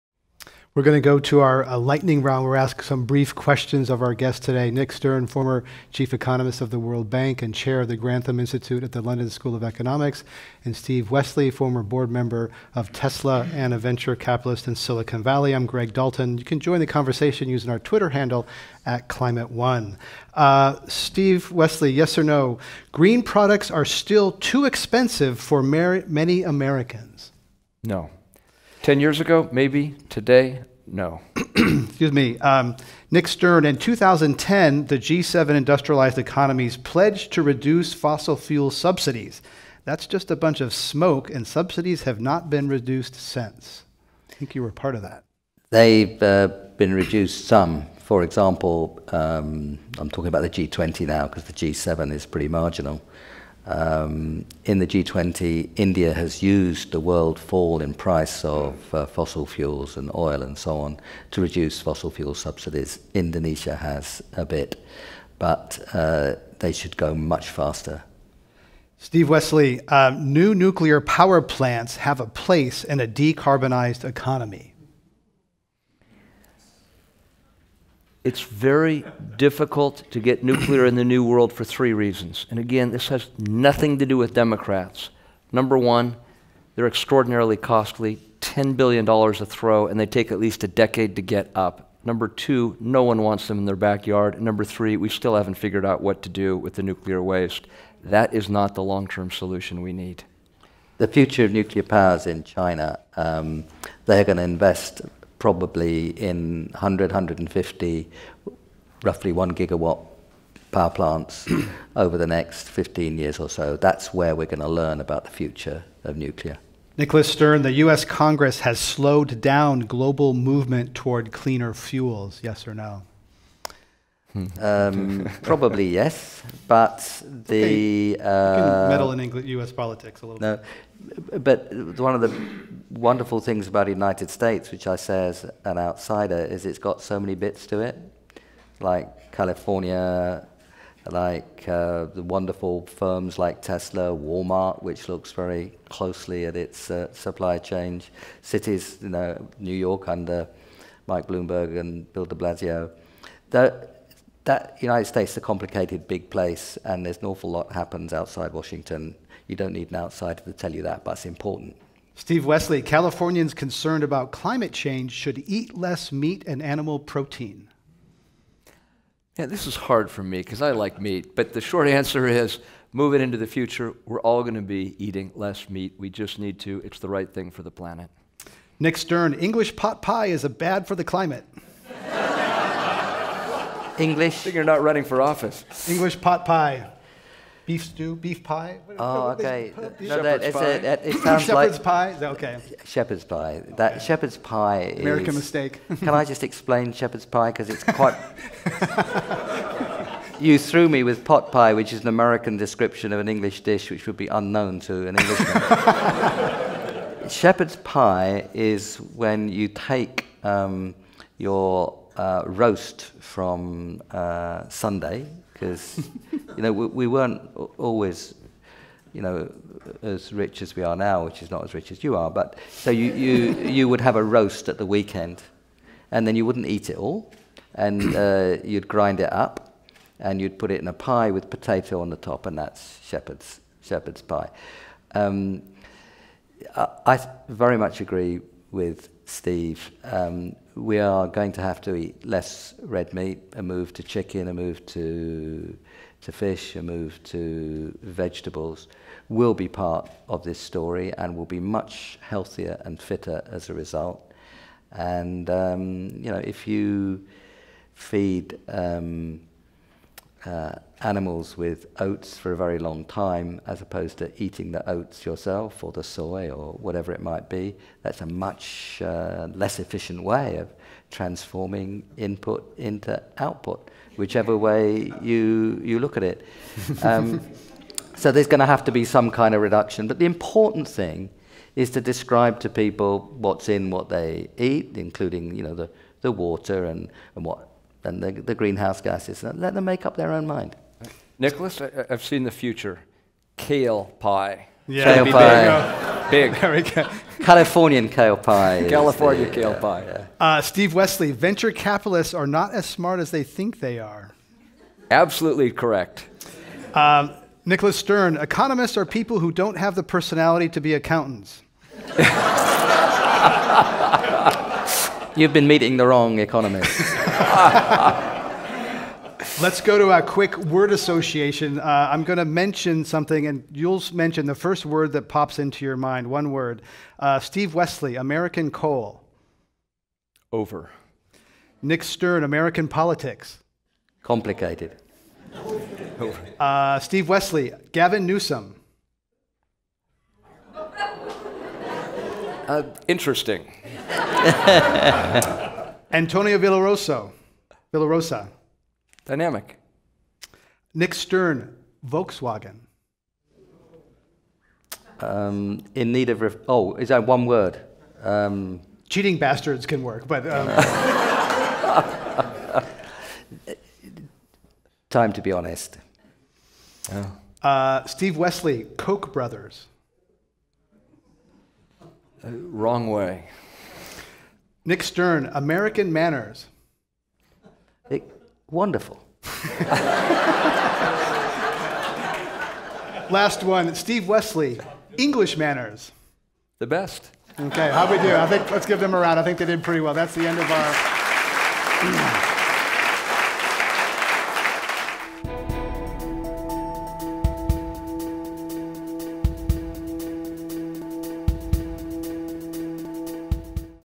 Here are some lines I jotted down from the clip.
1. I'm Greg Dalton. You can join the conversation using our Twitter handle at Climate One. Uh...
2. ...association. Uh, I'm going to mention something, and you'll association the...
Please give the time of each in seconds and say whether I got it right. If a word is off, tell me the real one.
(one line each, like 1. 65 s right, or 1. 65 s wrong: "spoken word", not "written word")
1. 15 s right
2. 320 s wrong: "mention", not "association".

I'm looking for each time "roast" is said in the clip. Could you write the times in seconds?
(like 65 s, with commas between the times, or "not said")
212 s, 224 s.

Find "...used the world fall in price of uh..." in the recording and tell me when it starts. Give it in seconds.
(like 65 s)
56 s.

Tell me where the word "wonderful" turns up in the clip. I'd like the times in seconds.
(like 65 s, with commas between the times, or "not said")
132 s, 142 s, 378 s.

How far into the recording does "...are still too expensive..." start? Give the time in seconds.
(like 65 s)
23 s.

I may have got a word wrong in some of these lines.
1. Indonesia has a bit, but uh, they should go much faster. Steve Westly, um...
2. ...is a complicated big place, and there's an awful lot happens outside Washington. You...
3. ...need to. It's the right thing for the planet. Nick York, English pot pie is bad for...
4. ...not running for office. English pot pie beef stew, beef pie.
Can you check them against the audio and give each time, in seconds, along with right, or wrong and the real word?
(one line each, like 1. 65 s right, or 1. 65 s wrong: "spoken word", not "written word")
1. 63 s right
2. 155 s right
3. 176 s wrong: "Stern", not "York"
4. 184 s right.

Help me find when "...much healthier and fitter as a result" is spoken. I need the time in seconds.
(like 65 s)
251 s.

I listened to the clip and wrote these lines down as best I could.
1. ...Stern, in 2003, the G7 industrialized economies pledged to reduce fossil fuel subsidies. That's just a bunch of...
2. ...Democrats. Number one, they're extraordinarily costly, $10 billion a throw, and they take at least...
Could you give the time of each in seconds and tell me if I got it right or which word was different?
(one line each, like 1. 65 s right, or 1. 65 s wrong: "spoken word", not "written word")
1. 33 s wrong: "2010", not "2003"
2. 84 s right.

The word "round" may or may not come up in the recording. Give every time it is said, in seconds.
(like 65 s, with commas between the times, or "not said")
2 s, 389 s.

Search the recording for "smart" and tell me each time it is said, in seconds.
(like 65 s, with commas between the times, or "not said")
302 s.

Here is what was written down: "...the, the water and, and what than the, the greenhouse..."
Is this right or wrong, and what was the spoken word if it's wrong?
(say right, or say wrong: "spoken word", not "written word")
right.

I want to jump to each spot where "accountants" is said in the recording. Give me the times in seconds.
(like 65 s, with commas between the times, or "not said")
310 s.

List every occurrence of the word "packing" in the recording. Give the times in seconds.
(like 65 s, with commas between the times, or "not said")
not said.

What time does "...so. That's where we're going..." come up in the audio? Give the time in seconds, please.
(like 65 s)
113 s.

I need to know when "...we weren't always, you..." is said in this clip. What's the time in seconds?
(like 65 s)
216 s.